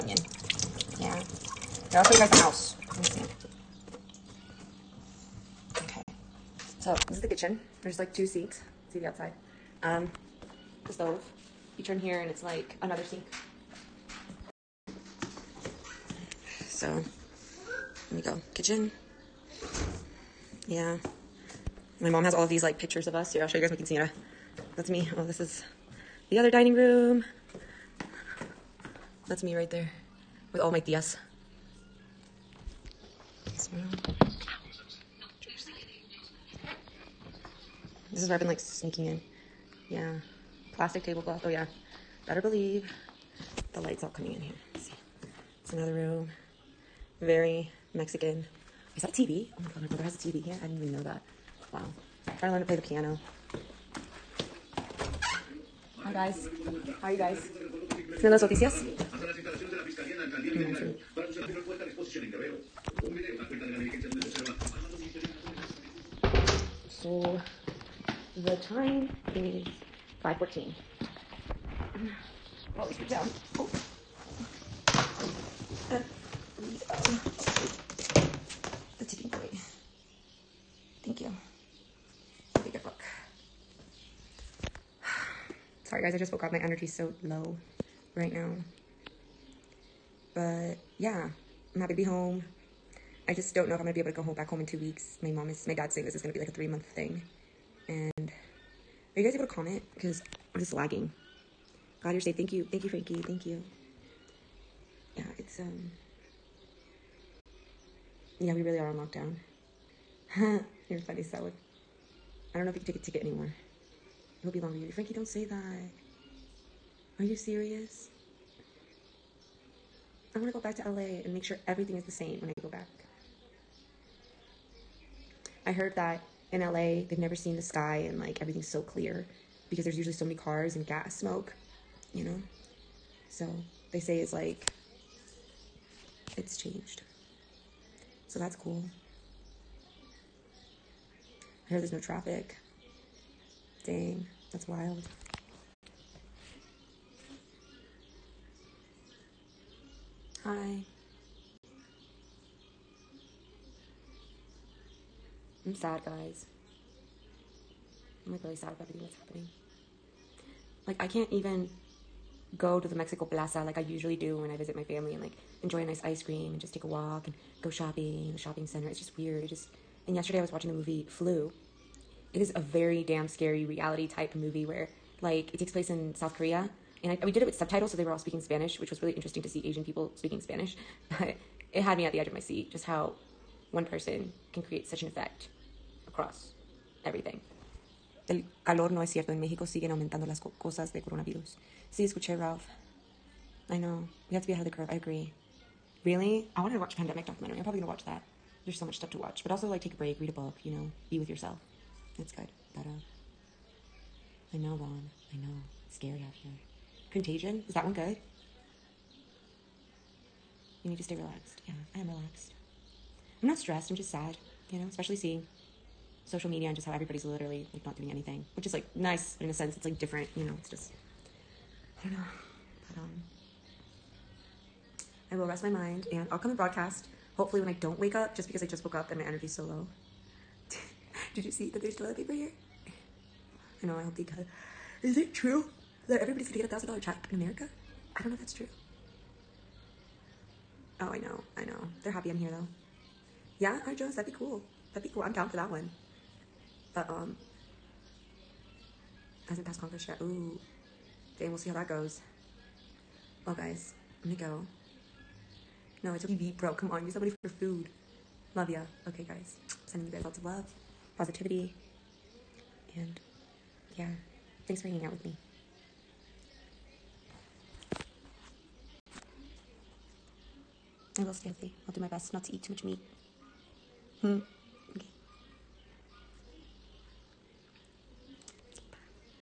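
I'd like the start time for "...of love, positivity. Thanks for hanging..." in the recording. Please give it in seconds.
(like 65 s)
260 s.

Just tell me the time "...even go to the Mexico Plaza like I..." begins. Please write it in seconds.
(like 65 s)
161 s.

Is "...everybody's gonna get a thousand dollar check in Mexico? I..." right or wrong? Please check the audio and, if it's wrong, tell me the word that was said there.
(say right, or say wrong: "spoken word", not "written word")
wrong: "America", not "Mexico".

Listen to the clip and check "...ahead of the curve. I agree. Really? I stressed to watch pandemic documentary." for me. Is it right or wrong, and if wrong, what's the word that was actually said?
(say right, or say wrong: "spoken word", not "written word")
wrong: "wanted", not "stressed".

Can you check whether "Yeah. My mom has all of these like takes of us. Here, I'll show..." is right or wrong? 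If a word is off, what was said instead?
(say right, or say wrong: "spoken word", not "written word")
wrong: "pictures", not "takes".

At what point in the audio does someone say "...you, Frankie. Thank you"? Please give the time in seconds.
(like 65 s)
102 s.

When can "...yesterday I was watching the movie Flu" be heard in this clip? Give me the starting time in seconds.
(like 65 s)
170 s.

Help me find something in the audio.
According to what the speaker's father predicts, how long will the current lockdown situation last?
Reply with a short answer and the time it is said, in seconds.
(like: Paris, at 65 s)
3 months, at 96 s.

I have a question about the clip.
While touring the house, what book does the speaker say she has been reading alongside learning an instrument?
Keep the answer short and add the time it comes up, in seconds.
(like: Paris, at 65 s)
The Tipping Point, at 78 s.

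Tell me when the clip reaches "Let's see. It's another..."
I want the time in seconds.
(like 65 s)
44 s.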